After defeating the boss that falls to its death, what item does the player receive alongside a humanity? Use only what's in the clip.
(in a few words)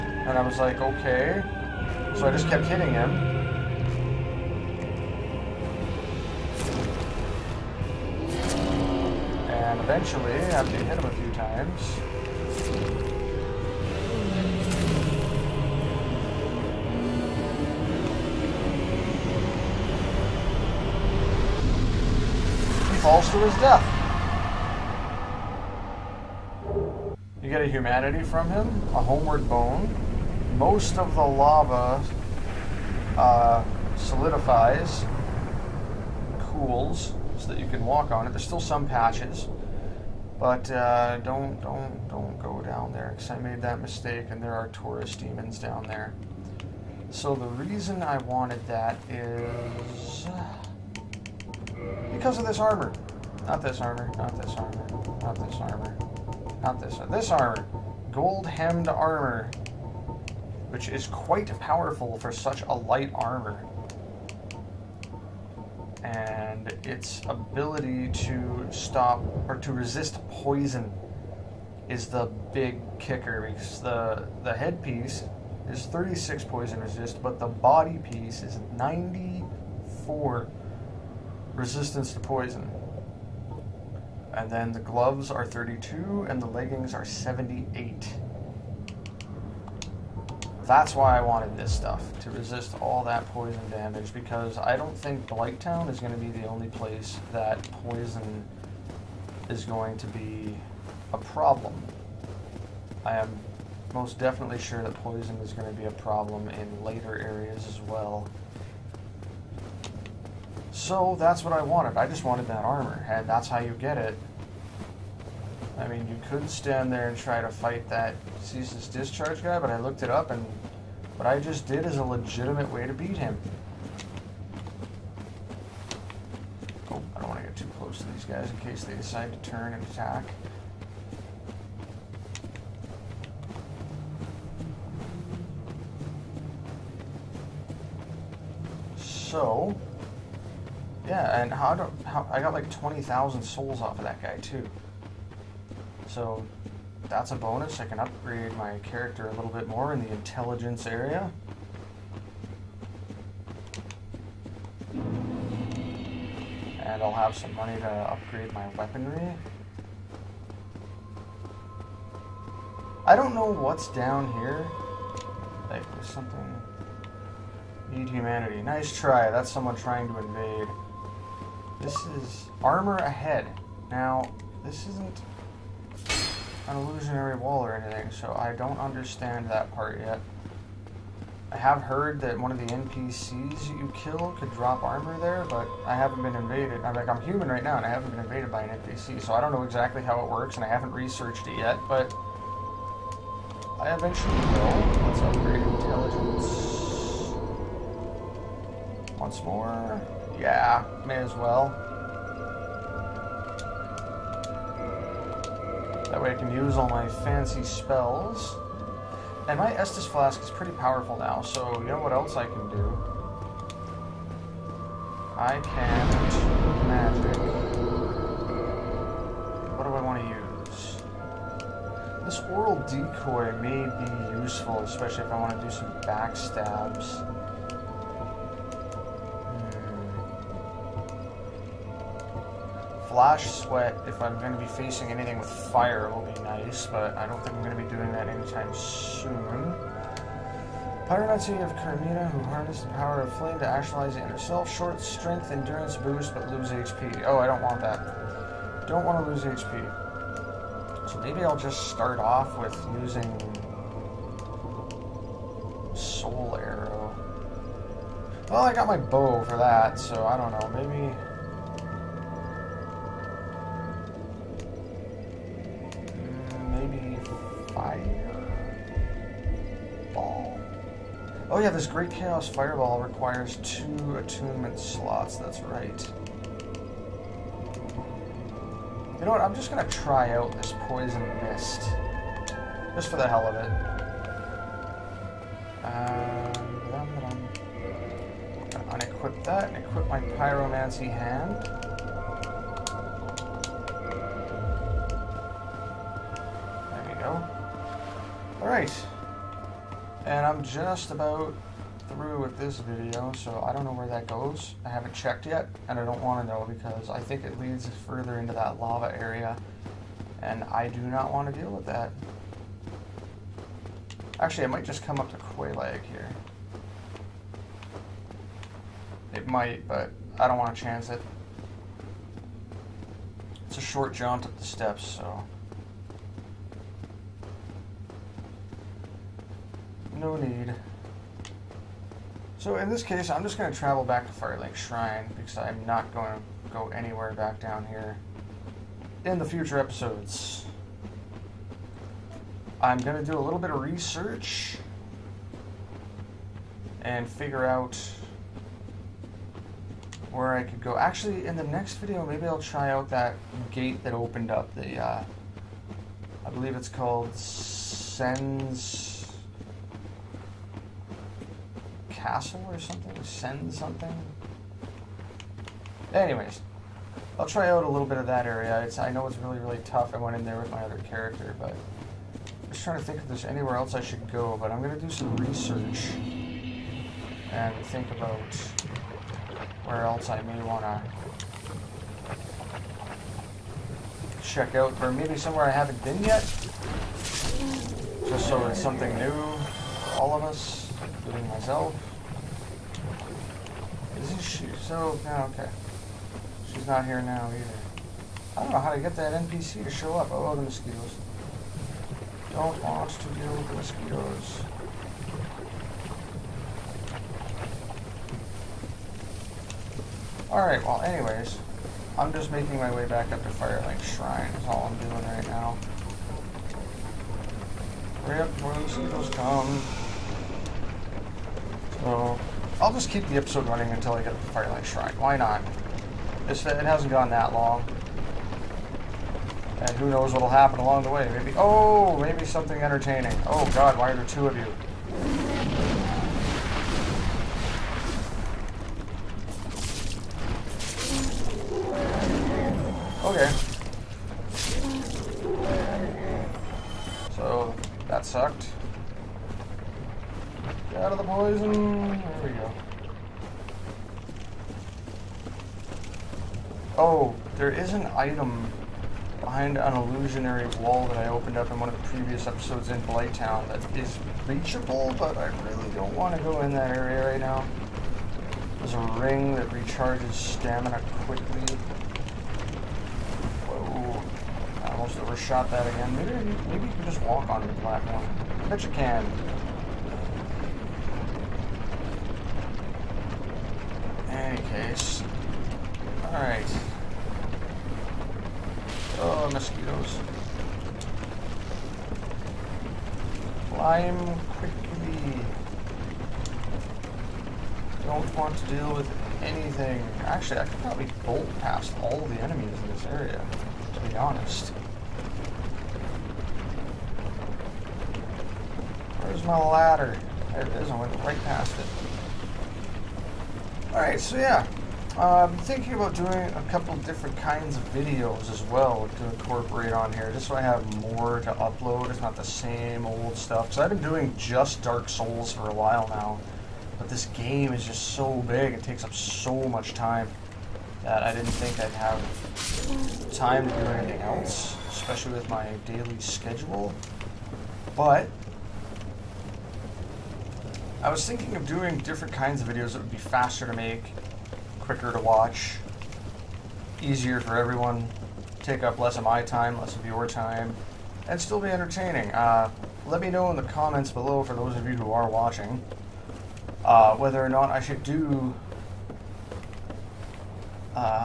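Homeward bone.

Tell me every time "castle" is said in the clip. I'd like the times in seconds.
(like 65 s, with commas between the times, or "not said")
362 s.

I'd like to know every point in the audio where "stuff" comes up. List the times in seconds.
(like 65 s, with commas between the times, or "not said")
91 s, 523 s.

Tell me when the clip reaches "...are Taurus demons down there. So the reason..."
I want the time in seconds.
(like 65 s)
44 s.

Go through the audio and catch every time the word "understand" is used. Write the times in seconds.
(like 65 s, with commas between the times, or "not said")
178 s.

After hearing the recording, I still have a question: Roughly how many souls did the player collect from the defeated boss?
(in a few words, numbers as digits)
20,000.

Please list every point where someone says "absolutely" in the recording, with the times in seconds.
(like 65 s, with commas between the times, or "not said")
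not said.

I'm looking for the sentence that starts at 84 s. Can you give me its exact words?
And then the gloves are 32 and the leggings are 78.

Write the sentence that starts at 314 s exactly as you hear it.
Actually, I might just come up to Quelaag here.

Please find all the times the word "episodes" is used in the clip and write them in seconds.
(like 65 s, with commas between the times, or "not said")
339 s, 423 s, 462 s.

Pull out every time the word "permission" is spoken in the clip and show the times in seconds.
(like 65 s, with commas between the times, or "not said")
not said.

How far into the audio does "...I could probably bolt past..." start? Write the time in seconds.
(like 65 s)
500 s.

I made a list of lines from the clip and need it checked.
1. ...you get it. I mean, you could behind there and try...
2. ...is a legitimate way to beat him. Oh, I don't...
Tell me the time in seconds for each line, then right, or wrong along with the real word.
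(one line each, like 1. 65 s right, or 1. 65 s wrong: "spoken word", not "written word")
1. 113 s wrong: "stand", not "behind"
2. 121 s right.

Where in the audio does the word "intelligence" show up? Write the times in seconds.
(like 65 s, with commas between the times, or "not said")
150 s, 195 s.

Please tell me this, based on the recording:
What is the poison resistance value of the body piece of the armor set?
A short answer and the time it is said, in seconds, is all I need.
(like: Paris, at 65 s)
94, at 78 s.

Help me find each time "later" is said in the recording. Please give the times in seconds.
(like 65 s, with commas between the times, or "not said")
106 s.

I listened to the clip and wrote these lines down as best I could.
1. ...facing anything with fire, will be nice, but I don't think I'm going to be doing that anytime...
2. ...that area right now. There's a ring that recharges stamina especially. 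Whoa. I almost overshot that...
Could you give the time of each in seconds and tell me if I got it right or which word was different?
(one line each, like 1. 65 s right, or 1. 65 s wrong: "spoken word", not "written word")
1. 234 s right
2. 466 s wrong: "quickly", not "especially".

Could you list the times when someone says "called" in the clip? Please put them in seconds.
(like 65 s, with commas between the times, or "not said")
356 s.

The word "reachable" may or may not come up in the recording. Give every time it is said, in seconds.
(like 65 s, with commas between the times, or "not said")
464 s.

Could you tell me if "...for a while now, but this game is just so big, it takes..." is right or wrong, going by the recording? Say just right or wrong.
right.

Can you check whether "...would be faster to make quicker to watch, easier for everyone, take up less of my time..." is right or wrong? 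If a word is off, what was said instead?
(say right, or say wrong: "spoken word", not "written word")
right.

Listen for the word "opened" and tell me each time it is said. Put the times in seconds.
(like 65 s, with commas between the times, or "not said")
354 s, 461 s.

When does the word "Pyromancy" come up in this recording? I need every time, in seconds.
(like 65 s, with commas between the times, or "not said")
241 s, 290 s.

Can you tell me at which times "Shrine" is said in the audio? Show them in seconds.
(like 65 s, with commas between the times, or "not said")
334 s, 414 s, 424 s.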